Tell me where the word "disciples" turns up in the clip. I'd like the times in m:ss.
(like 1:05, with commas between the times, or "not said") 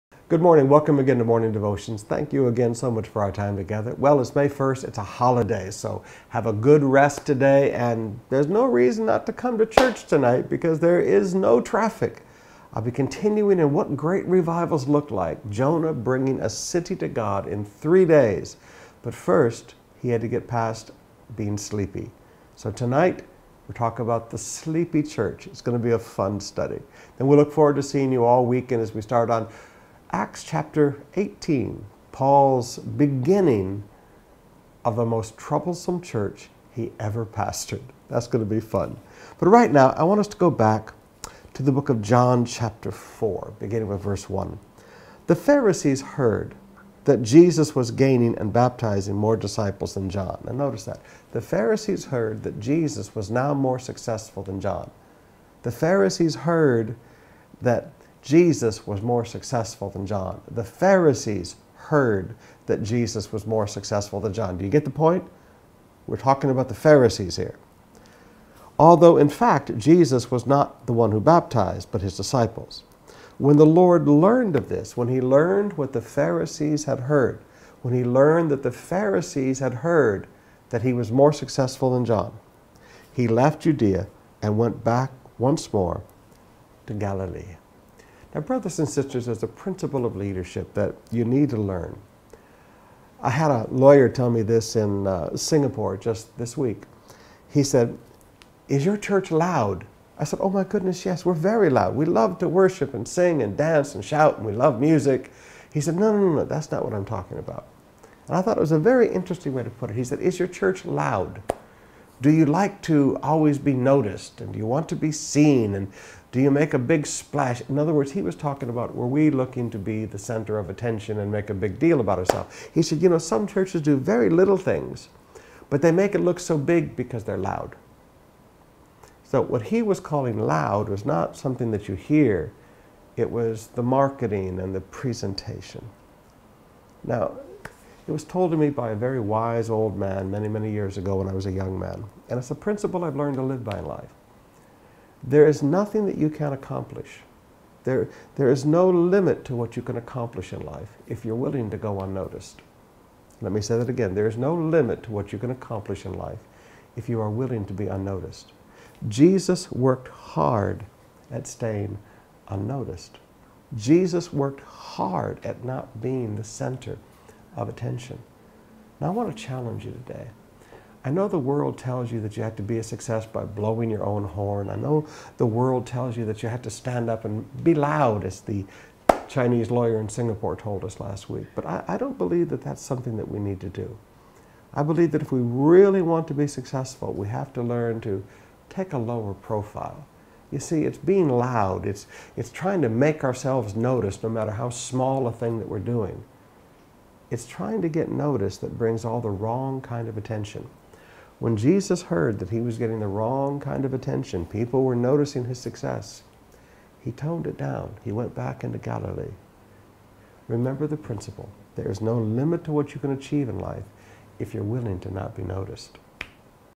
0:49, 1:12.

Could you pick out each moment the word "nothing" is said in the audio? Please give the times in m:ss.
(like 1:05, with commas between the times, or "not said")
2:25.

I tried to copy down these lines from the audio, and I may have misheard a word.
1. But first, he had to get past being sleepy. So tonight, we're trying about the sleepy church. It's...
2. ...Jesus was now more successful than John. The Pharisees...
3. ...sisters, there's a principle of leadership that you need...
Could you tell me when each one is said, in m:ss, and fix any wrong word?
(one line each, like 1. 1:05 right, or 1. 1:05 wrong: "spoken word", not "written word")
1. 0:19 wrong: "talking", not "trying"
2. 0:52 right
3. 1:28 right.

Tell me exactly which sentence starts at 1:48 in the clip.
And I thought it was a very interesting way to put it.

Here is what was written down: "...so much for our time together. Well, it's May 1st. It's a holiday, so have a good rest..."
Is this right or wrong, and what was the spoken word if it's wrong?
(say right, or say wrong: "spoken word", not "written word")
right.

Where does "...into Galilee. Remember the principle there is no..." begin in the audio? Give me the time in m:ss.
3:28.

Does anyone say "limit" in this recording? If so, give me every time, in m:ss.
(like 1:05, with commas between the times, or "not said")
2:28, 2:34, 3:32.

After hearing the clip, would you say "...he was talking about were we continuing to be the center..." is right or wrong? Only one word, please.
wrong.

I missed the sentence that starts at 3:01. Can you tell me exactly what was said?
But I, I don't believe that that's something that we need to do.